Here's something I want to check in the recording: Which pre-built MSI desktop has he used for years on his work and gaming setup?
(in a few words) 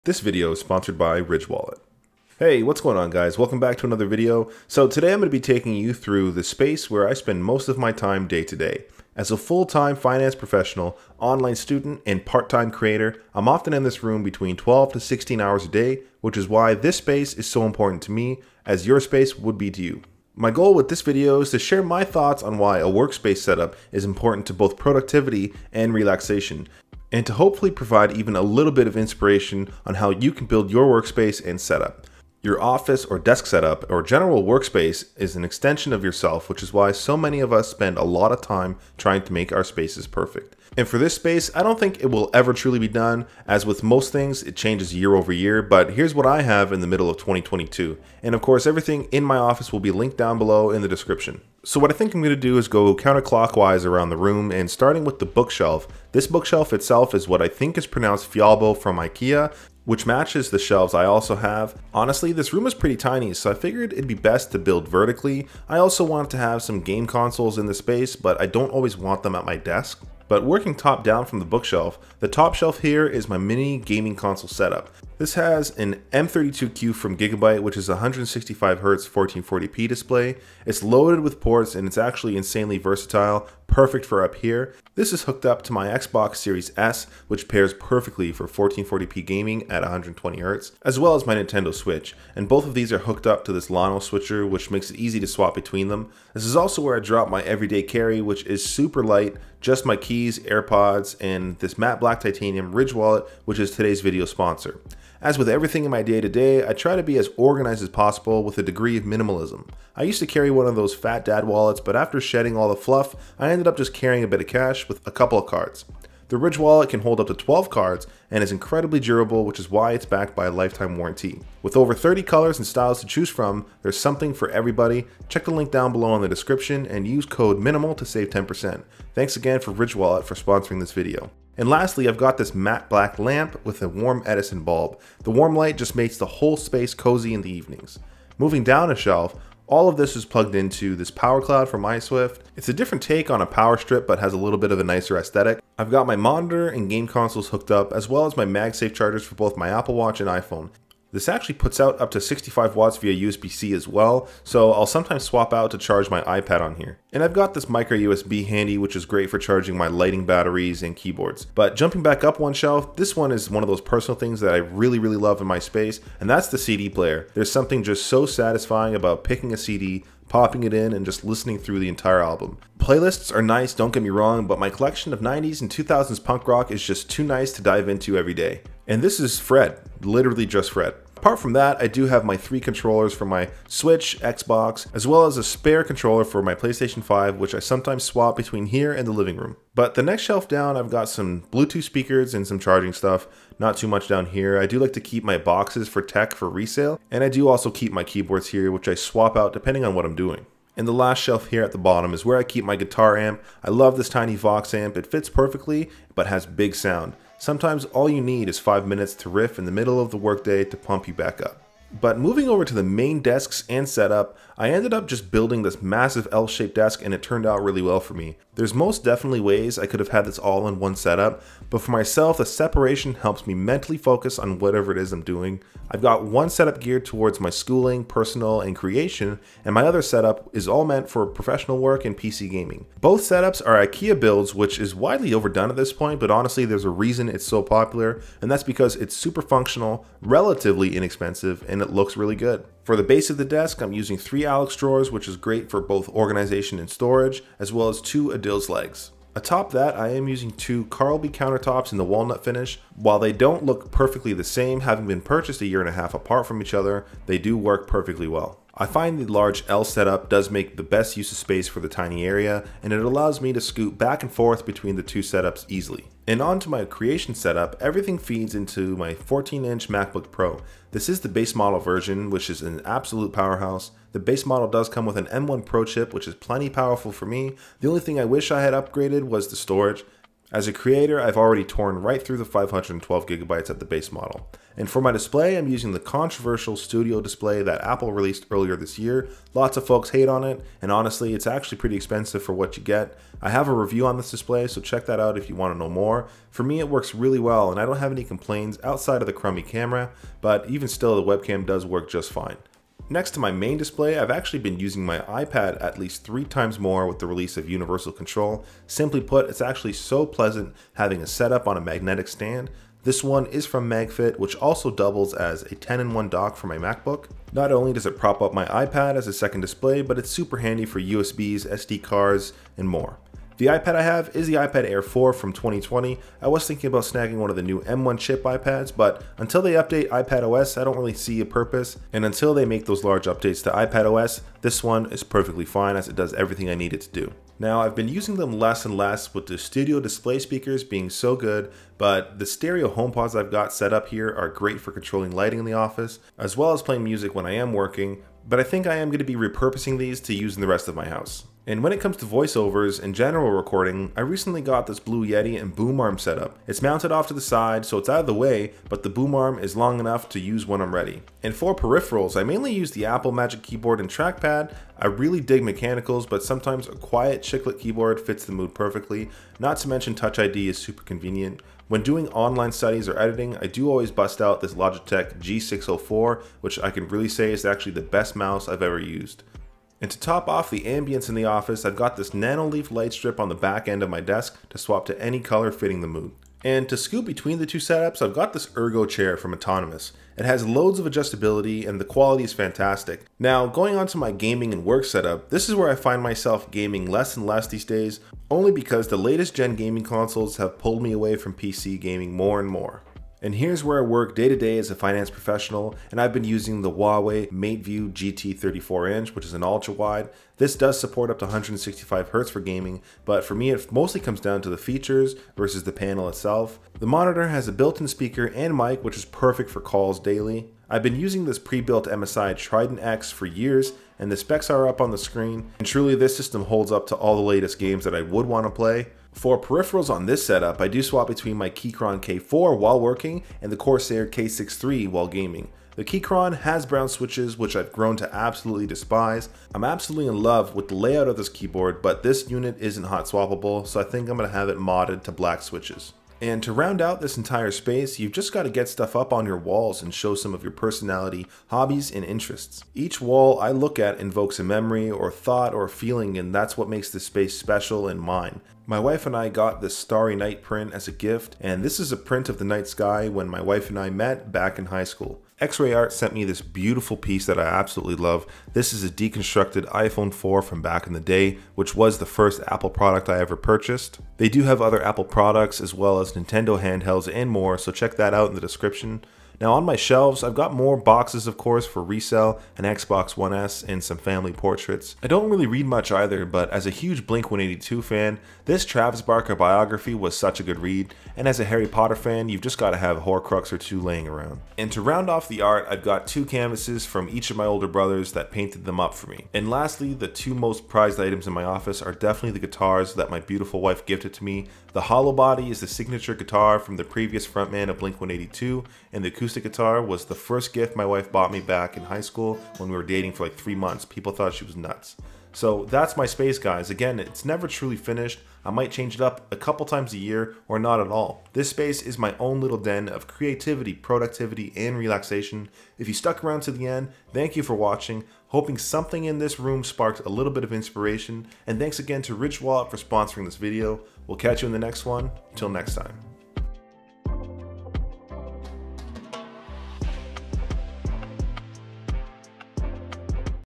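Trident X.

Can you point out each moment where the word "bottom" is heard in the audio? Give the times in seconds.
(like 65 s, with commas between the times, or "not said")
201 s.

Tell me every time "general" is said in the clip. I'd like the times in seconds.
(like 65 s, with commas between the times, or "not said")
34 s, 353 s.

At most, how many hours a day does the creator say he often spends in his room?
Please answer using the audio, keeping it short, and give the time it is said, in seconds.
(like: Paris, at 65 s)
16, at 14 s.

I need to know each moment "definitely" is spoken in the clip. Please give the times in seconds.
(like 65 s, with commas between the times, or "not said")
219 s, 502 s.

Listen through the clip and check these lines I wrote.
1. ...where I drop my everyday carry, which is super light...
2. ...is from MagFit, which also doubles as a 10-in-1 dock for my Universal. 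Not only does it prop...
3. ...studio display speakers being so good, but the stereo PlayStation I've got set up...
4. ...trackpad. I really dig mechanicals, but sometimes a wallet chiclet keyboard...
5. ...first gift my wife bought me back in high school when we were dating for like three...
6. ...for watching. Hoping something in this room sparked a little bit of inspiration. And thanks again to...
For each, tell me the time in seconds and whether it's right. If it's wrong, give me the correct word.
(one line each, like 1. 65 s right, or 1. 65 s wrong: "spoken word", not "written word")
1. 96 s right
2. 313 s wrong: "MacBook", not "Universal"
3. 339 s wrong: "HomePods", not "PlayStation"
4. 364 s wrong: "quiet", not "wallet"
5. 510 s right
6. 527 s right.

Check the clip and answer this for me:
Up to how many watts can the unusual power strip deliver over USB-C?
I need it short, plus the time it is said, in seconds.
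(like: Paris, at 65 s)
65, at 152 s.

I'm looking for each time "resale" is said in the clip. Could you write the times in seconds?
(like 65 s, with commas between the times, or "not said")
196 s, 482 s.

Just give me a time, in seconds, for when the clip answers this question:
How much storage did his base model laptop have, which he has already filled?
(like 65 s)
282 s.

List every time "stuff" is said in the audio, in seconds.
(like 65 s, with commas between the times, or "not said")
192 s, 448 s.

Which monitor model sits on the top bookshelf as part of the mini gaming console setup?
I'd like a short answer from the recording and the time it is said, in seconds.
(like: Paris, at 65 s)
M32Q, at 76 s.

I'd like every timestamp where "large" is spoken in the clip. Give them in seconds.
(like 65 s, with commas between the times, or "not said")
259 s, 333 s.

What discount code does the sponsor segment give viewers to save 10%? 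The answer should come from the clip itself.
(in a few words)
MINIMAL.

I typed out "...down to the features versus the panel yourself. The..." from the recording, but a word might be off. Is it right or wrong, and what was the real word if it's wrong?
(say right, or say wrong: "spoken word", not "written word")
wrong: "itself", not "yourself".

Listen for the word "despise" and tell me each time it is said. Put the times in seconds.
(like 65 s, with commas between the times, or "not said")
438 s.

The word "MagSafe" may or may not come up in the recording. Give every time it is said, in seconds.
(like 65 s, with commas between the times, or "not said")
148 s.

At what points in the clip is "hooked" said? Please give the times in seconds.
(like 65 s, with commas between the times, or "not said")
85 s, 92 s, 147 s.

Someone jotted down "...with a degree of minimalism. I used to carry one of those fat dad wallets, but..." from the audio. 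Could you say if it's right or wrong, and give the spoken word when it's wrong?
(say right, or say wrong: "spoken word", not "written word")
right.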